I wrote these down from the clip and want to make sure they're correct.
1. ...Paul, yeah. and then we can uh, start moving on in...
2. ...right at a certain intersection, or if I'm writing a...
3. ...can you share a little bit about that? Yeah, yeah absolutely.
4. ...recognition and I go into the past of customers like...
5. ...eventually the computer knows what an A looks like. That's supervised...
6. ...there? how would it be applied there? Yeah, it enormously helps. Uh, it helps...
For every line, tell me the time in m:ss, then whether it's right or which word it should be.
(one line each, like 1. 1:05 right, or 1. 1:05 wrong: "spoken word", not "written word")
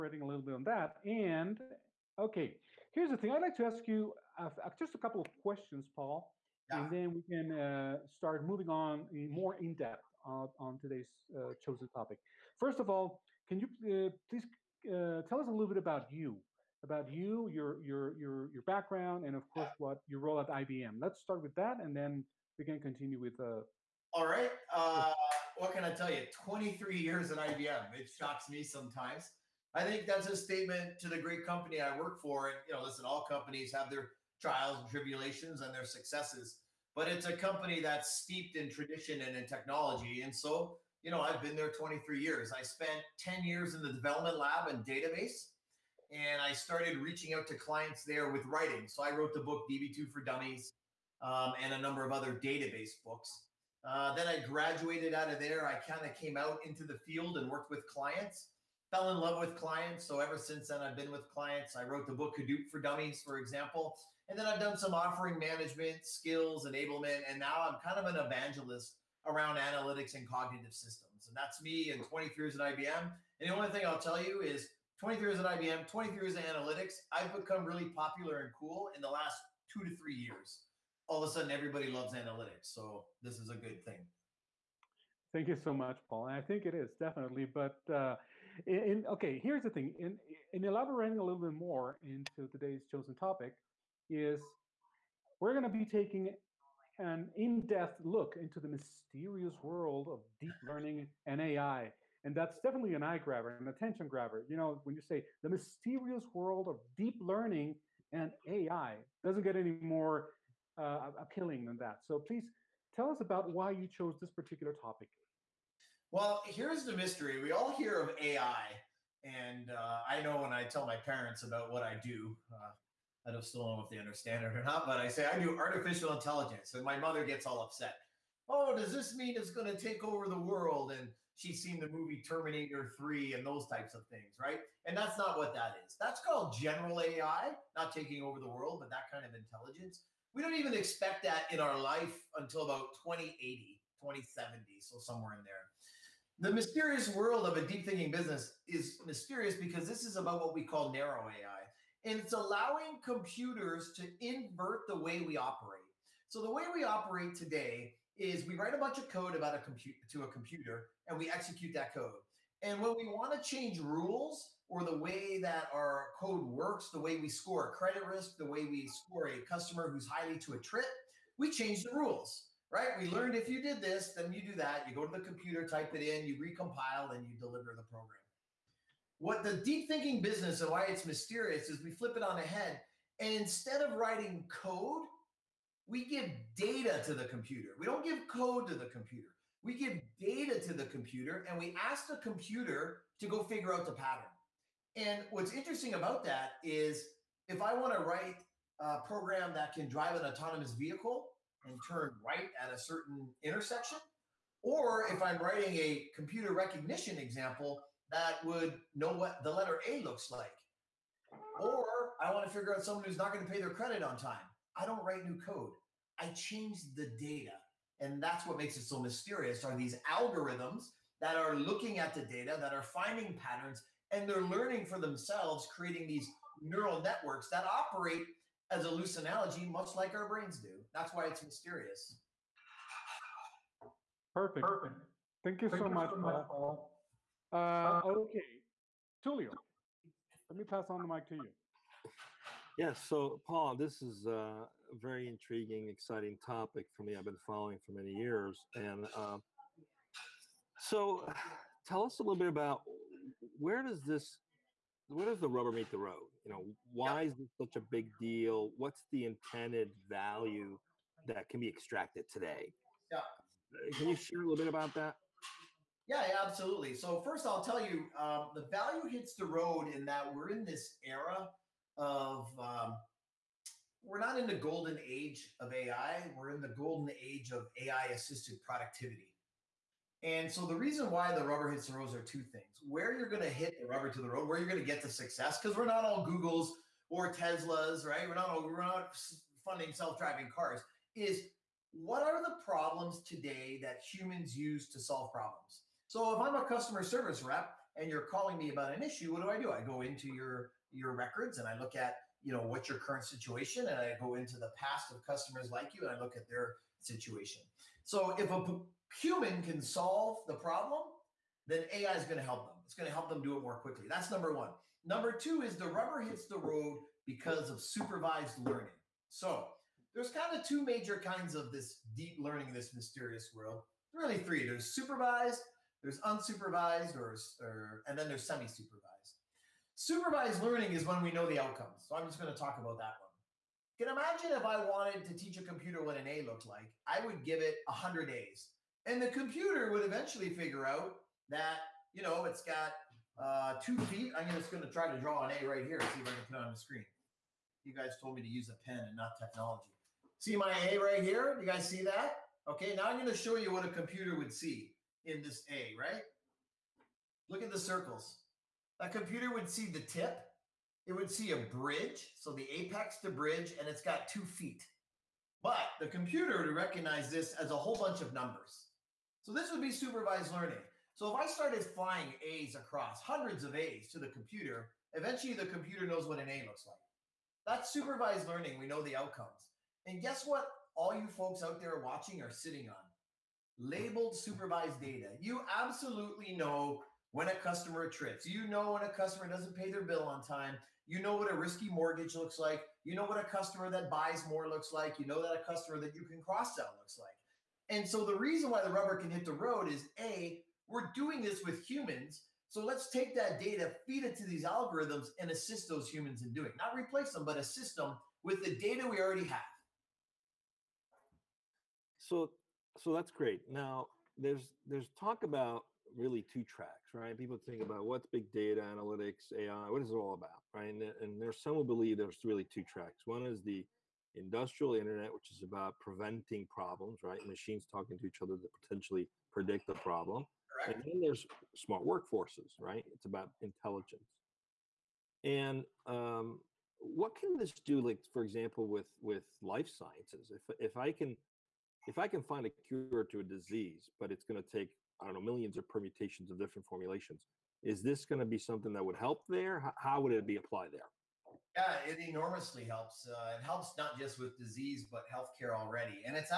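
1. 0:05 right
2. 3:22 right
3. 4:23 right
4. 5:03 wrong: "situation", not "recognition"
5. 6:15 right
6. 7:29 right.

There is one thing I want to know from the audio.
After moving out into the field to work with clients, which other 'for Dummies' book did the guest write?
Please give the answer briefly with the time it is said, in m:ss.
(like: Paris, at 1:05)
Hadoop for Dummies, at 1:02.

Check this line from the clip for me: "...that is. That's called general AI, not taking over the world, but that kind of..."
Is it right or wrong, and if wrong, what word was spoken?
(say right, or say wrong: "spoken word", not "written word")
right.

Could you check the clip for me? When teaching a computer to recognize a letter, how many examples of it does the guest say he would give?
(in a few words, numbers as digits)
100.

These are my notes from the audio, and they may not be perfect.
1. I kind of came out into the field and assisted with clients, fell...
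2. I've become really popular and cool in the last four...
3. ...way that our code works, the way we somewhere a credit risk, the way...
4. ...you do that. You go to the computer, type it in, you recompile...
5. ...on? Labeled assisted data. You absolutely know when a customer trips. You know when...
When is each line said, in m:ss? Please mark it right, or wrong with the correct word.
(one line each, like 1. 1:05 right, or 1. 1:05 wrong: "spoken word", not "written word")
1. 0:55 wrong: "worked", not "assisted"
2. 1:17 wrong: "two", not "four"
3. 2:44 wrong: "score", not "somewhere"
4. 2:54 right
5. 6:22 wrong: "supervised", not "assisted".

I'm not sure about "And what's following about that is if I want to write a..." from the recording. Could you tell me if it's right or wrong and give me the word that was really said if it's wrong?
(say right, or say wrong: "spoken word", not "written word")
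wrong: "interesting", not "following".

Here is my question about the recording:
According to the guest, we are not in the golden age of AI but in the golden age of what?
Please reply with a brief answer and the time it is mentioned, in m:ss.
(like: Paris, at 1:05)
AI assisted productivity, at 4:37.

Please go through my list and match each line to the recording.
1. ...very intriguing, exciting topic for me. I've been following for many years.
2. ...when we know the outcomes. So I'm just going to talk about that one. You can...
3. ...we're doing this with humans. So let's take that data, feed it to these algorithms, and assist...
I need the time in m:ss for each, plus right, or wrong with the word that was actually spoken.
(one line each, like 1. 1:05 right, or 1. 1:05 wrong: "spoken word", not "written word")
1. 4:04 right
2. 5:31 right
3. 6:40 right.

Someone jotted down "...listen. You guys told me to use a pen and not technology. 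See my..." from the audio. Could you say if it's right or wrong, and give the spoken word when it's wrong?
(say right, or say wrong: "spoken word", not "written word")
wrong: "screen", not "listen".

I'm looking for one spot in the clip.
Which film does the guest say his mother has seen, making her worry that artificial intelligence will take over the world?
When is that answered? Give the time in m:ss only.
2:12.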